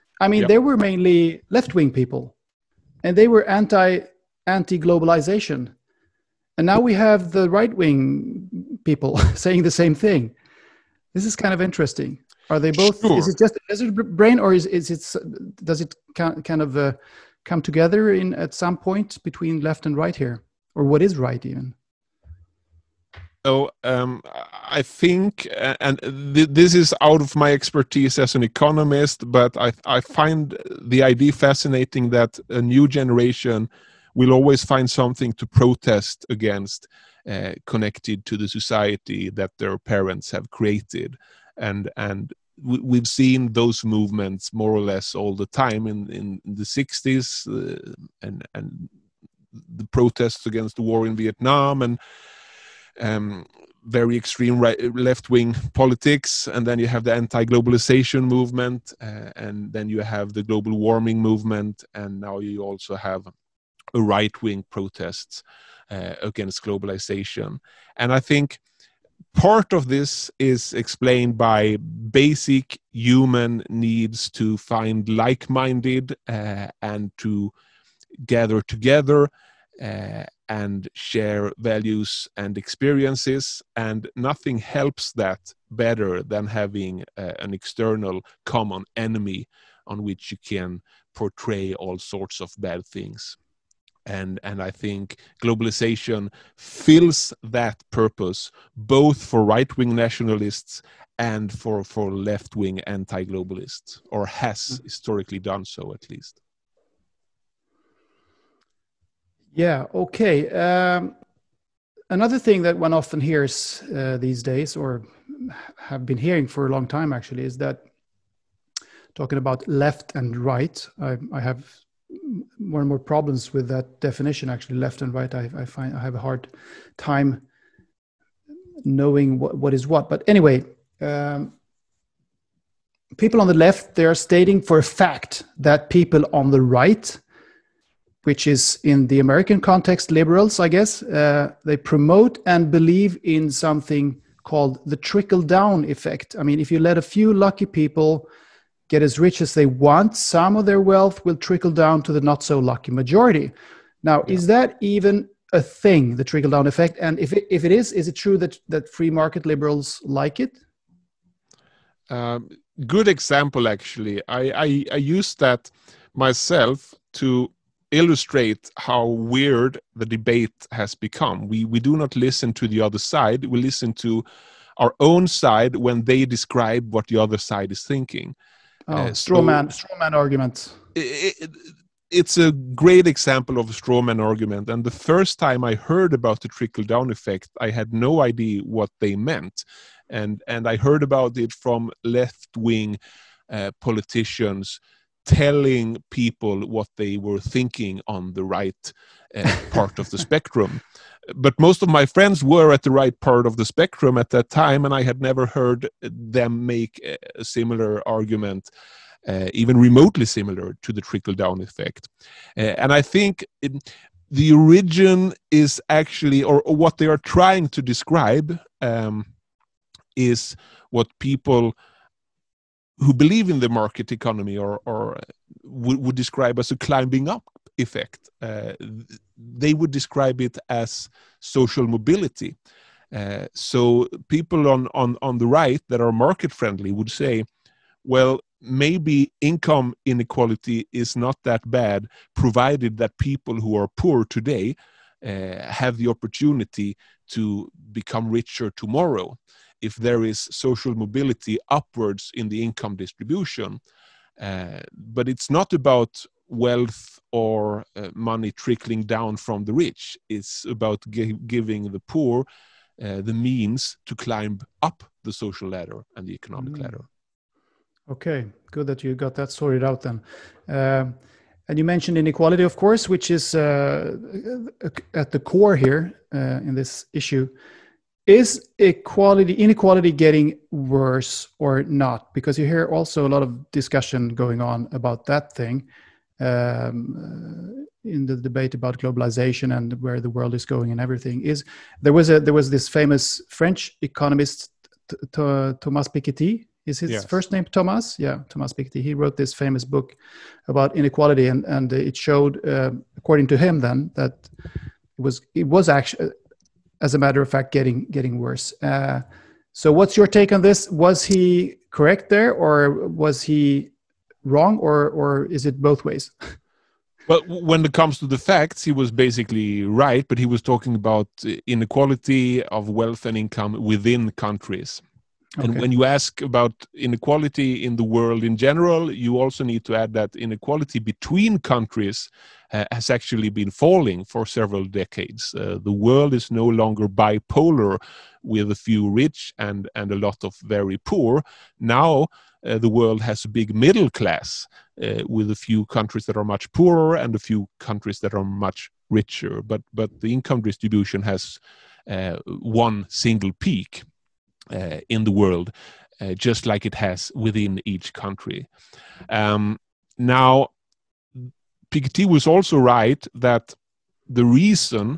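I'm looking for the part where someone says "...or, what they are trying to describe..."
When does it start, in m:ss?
3:36.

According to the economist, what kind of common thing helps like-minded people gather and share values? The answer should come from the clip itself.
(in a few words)
external common enemy.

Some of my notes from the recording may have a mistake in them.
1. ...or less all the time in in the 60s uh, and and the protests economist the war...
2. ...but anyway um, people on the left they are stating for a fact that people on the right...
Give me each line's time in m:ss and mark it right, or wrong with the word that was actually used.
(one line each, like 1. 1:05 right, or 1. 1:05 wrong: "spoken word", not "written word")
1. 0:44 wrong: "against", not "economist"
2. 2:10 right.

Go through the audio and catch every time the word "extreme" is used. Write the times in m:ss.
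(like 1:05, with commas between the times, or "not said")
0:54.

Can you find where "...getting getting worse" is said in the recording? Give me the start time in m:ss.
5:07.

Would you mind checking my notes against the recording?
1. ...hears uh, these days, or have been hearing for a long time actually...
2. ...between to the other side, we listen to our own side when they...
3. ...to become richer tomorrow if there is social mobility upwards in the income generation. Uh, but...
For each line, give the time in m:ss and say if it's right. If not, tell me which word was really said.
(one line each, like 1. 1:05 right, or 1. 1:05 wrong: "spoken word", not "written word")
1. 1:53 right
2. 2:52 wrong: "listen", not "between"
3. 4:07 wrong: "distribution", not "generation".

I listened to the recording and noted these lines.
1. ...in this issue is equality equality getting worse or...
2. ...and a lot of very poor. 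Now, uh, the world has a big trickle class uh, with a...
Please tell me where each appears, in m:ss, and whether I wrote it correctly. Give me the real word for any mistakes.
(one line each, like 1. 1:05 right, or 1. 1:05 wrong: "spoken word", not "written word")
1. 4:36 wrong: "inequality", not "equality"
2. 5:39 wrong: "middle", not "trickle".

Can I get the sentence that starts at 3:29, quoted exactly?
Uh, even remotely similar to the trickle down effect.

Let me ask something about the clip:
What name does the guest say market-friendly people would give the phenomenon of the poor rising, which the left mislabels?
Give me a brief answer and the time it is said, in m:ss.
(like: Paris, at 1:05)
climbing up effect, at 3:46.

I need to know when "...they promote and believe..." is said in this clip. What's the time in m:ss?
2:21.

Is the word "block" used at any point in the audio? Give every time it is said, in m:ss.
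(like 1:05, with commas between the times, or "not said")
not said.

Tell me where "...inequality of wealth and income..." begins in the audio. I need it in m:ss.
5:21.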